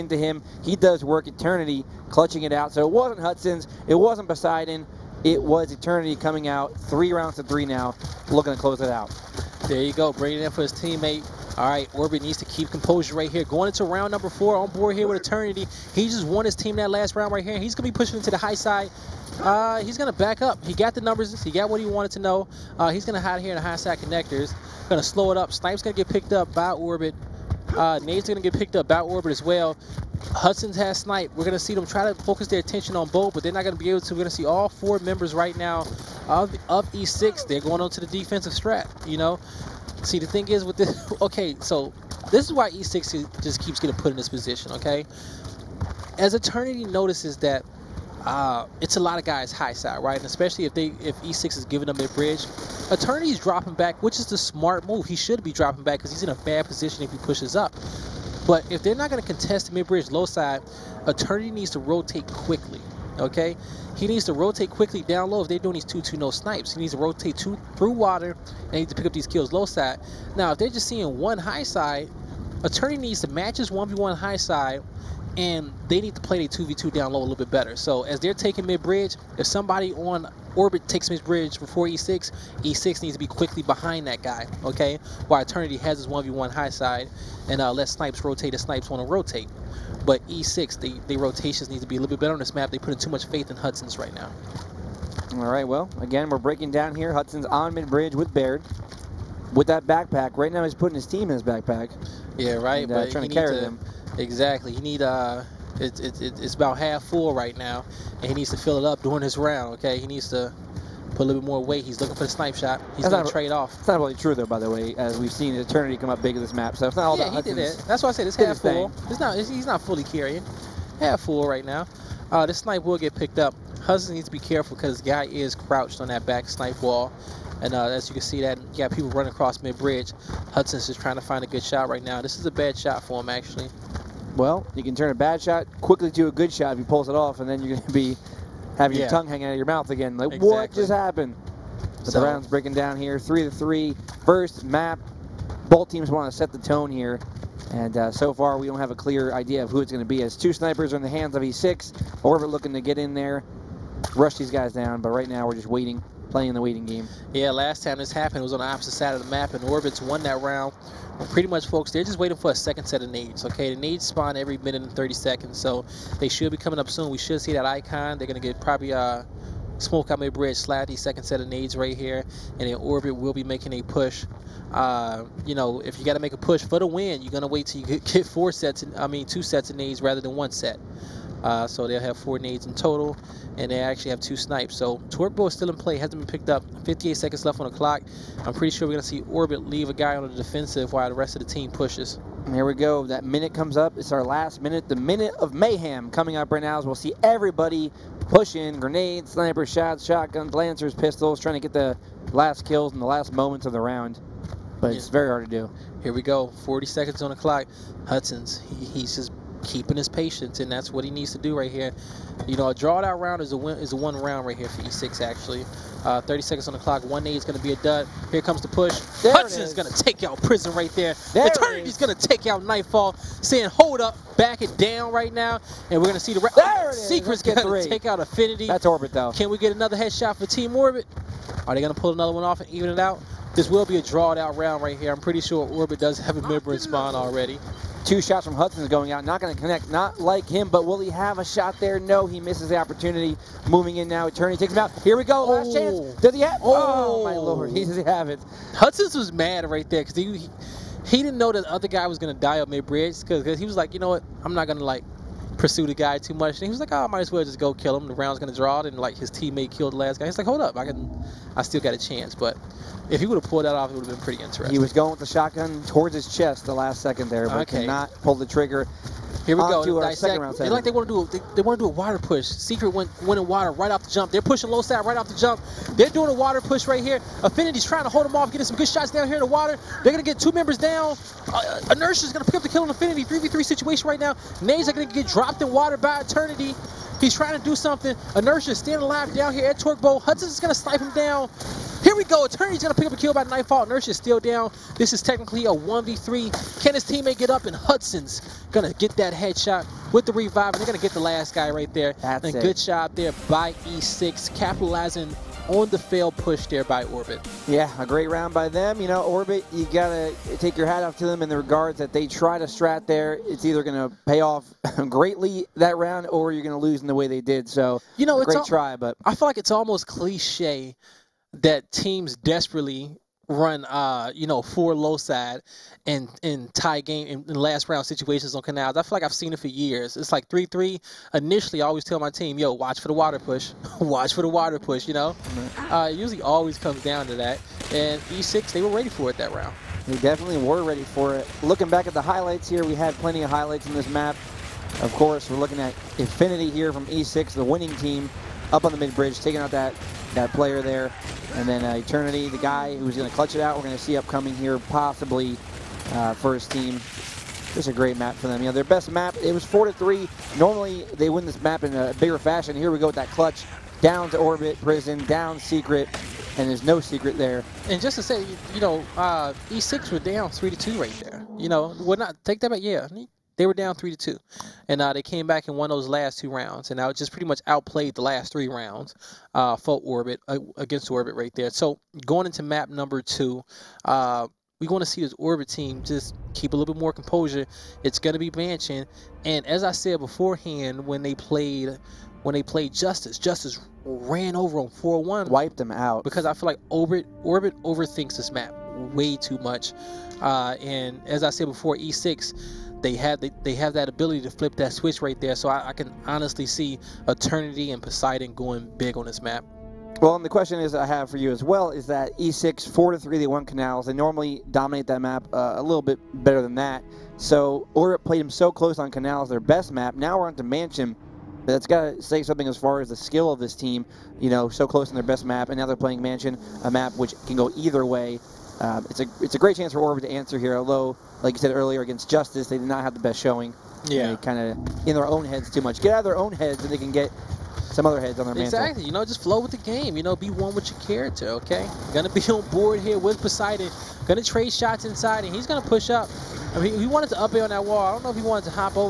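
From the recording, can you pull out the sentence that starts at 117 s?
That's why I said it's half full.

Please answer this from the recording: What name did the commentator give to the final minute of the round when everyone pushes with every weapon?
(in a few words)
minute of mayhem.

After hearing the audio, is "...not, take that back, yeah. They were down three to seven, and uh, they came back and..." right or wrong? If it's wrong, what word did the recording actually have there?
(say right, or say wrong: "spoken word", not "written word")
wrong: "two", not "seven".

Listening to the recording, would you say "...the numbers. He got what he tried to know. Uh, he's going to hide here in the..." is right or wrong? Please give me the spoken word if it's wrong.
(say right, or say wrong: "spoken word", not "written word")
wrong: "wanted", not "tried".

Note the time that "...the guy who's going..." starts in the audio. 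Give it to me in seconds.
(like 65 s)
352 s.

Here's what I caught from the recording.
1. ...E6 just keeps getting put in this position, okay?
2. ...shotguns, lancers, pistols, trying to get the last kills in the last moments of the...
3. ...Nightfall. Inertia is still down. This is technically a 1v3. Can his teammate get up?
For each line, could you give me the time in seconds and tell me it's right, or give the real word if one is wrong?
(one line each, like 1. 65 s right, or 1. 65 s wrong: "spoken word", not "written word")
1. 42 s right
2. 200 s right
3. 293 s right.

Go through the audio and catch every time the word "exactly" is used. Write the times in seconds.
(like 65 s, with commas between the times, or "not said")
104 s, 140 s, 438 s.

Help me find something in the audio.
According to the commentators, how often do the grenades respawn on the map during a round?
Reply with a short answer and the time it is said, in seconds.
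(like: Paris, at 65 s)
every 1 minute 30 seconds, at 164 s.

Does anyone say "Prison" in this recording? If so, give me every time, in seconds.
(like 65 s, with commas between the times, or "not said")
220 s, 364 s.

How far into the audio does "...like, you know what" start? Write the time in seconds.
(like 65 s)
253 s.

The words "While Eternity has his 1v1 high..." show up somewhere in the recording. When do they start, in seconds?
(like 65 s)
85 s.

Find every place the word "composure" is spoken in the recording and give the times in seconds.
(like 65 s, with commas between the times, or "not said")
12 s, 387 s.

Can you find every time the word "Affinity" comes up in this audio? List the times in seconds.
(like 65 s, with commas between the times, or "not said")
228 s, 277 s, 282 s, 346 s.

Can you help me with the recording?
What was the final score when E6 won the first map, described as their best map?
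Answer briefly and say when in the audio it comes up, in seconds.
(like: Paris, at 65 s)
4-3, at 359 s.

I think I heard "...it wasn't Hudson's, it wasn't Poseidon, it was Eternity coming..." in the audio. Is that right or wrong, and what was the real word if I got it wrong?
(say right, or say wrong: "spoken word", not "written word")
right.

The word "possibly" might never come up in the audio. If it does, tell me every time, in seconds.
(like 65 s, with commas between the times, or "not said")
354 s.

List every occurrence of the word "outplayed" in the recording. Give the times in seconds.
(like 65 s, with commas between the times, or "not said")
377 s.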